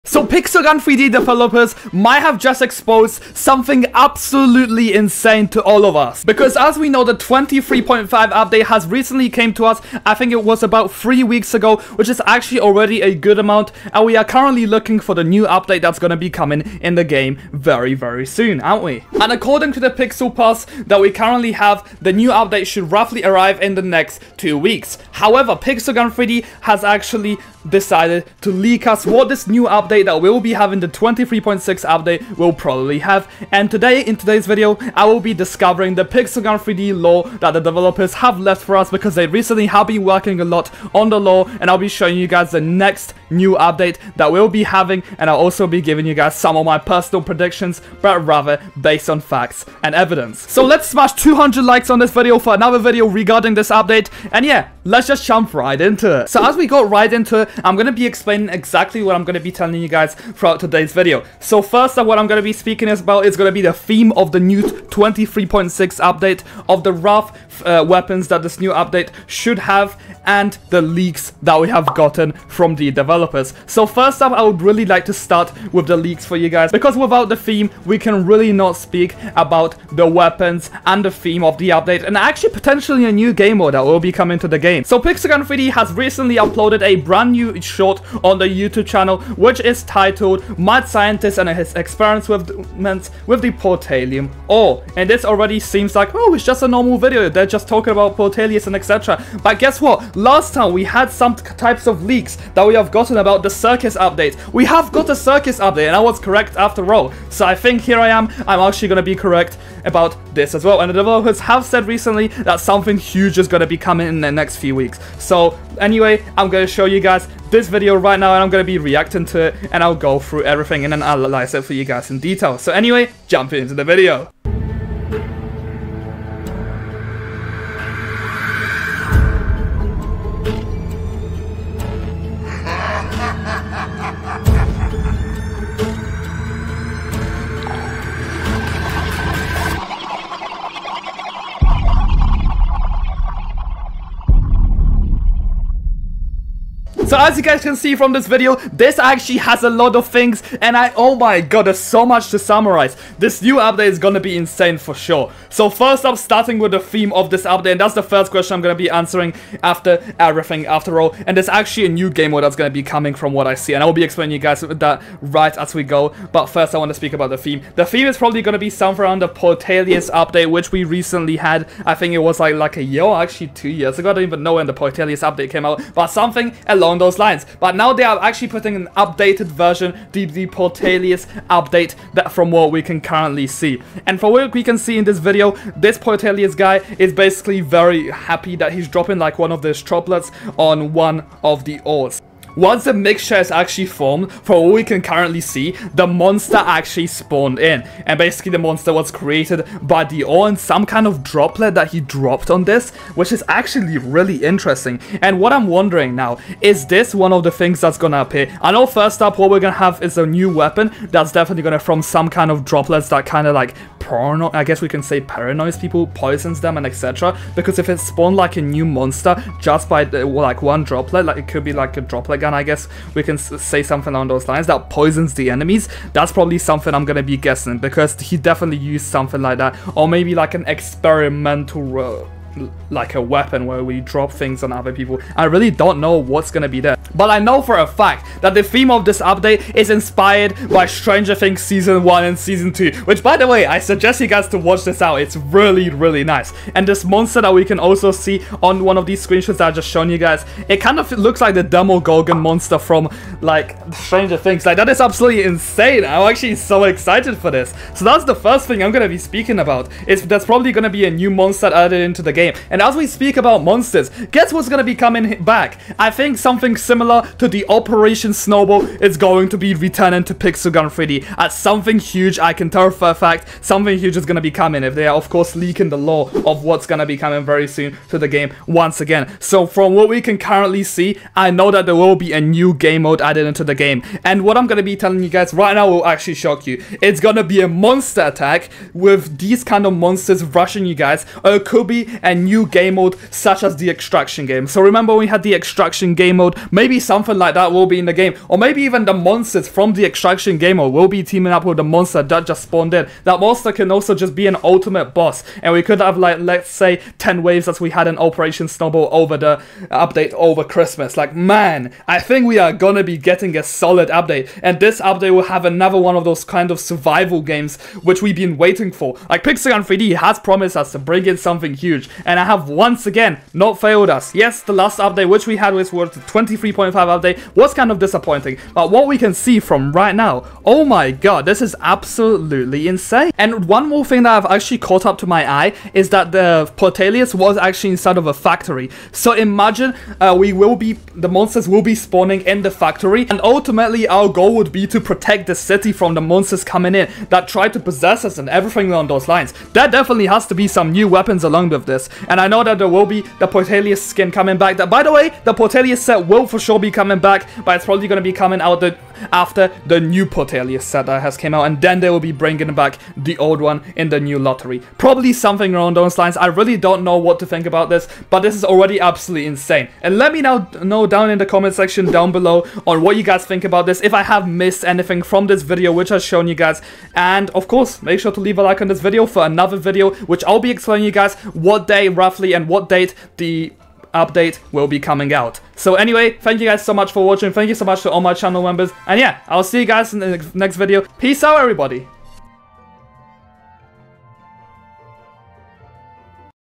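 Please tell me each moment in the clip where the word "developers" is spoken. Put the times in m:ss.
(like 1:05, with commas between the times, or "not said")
0:01, 0:37, 1:12, 1:50.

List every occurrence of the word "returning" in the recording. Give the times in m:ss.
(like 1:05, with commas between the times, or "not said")
4:29.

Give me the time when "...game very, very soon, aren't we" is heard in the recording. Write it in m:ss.
0:17.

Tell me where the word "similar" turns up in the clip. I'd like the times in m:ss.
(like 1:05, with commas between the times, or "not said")
4:26.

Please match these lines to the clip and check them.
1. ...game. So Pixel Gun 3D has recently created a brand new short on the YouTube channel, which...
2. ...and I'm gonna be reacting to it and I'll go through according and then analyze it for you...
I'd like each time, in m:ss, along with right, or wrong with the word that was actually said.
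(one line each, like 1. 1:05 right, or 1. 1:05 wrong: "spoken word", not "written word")
1. 1:24 wrong: "uploaded", not "created"
2. 1:58 wrong: "everything", not "according".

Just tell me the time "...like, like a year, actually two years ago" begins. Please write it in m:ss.
2:52.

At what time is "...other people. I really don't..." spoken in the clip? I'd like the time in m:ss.
3:54.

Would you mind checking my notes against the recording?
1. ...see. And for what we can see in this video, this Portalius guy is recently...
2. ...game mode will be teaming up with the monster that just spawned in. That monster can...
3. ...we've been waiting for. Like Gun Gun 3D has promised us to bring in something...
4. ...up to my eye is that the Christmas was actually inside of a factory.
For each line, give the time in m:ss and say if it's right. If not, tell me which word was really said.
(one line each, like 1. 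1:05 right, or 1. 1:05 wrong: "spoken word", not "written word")
1. 3:03 wrong: "basically", not "recently"
2. 5:00 right
3. 5:18 wrong: "Pixel", not "Gun"
4. 5:35 wrong: "Portalius", not "Christmas".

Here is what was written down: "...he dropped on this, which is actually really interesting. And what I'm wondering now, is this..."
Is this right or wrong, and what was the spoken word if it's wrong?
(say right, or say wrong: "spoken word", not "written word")
right.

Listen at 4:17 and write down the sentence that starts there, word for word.
So that's the first thing I'm gonna be speaking about.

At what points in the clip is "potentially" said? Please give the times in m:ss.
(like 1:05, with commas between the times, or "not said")
1:22.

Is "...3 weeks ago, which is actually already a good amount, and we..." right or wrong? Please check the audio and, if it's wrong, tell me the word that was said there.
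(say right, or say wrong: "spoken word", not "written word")
right.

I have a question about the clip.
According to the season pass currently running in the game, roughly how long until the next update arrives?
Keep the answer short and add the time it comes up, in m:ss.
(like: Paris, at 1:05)
2 weeks, at 0:23.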